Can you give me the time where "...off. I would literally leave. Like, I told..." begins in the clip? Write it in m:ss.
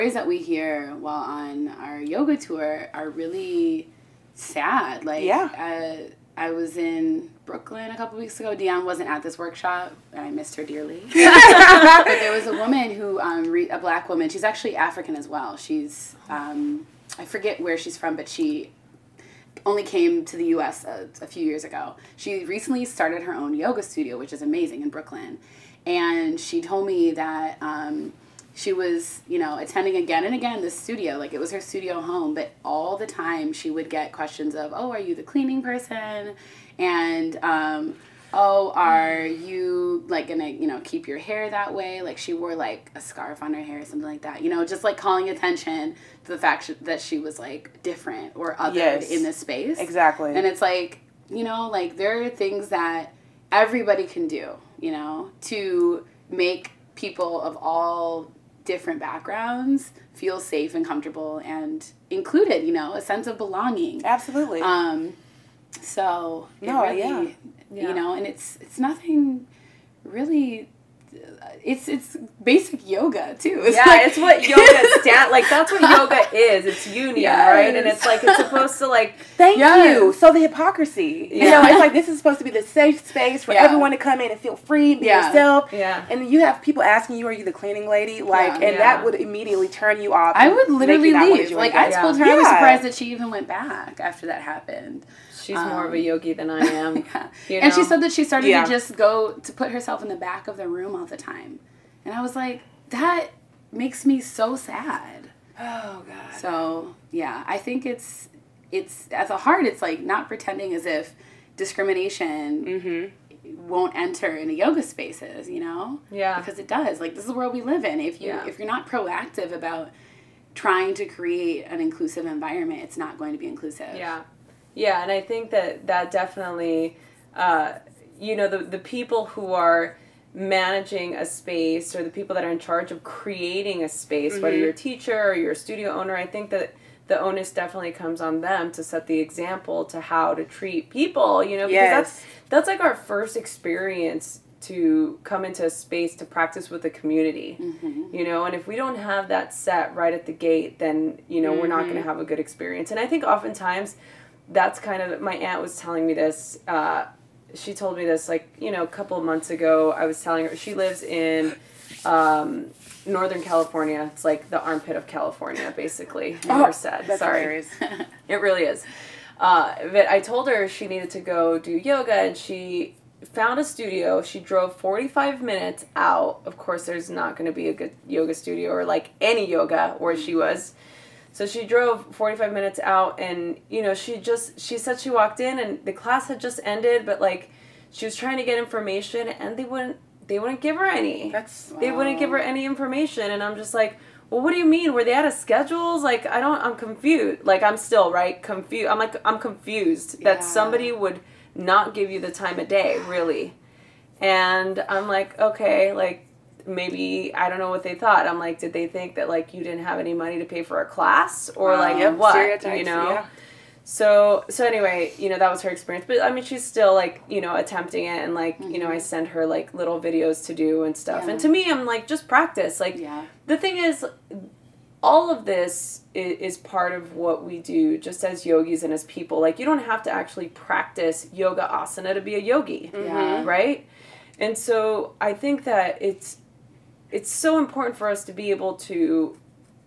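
1:30.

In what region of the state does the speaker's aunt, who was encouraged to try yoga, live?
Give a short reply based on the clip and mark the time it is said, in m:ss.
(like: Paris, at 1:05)
Northern California, at 2:43.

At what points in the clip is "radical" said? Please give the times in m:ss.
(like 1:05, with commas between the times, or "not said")
not said.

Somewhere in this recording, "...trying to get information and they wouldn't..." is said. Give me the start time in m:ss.
3:08.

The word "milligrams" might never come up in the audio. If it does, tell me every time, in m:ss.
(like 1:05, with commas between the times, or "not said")
not said.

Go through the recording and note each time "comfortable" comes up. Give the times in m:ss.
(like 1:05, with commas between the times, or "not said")
1:00.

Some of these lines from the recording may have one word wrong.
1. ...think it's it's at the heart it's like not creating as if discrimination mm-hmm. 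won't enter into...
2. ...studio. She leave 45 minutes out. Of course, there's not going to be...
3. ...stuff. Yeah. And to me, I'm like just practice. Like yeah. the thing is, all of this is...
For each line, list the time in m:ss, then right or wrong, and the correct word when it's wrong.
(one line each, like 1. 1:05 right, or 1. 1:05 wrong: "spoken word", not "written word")
1. 1:47 wrong: "pretending", not "creating"
2. 2:53 wrong: "drove", not "leave"
3. 3:40 right.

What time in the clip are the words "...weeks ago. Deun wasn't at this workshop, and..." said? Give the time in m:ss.
0:08.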